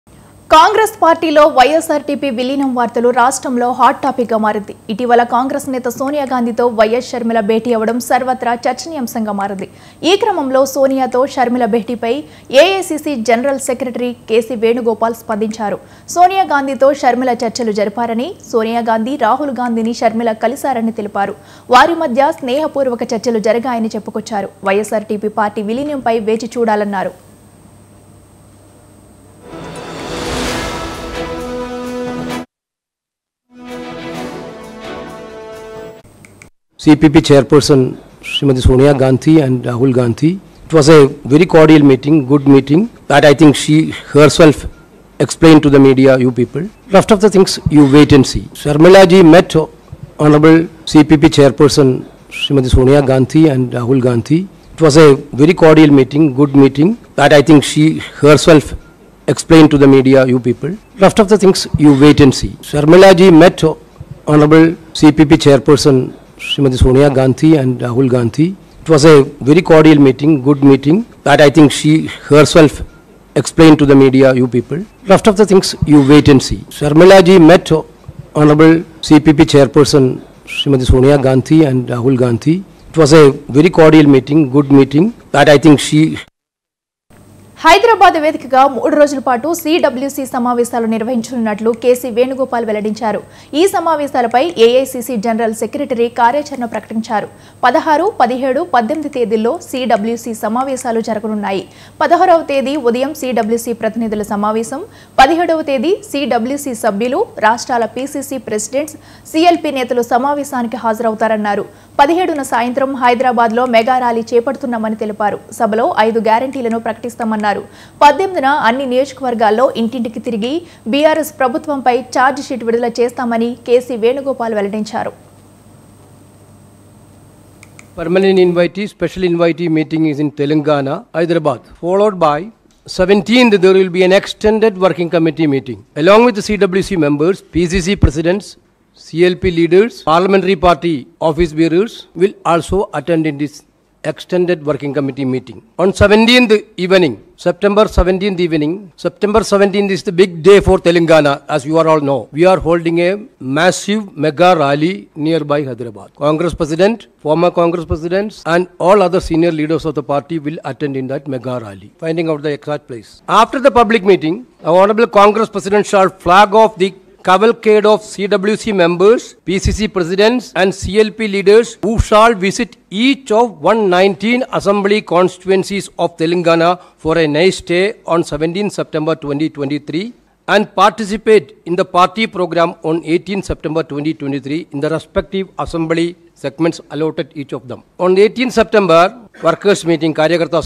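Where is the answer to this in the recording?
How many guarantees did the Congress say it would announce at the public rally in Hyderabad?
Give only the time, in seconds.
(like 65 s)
116 s.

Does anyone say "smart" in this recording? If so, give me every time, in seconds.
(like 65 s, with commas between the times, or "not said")
not said.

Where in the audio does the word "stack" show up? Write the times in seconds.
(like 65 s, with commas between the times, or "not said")
not said.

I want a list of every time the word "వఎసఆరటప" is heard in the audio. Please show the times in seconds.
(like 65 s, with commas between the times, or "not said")
1 s, 24 s.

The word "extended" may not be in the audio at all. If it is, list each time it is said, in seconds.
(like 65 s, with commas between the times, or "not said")
134 s, 144 s.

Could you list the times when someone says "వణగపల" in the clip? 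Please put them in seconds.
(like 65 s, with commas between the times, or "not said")
14 s, 92 s, 124 s.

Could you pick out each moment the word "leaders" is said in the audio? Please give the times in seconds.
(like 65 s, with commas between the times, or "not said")
139 s, 159 s, 171 s.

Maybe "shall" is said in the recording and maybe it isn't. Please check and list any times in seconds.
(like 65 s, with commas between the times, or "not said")
165 s, 172 s.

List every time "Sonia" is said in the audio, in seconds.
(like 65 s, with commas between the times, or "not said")
38 s, 52 s, 66 s, 80 s.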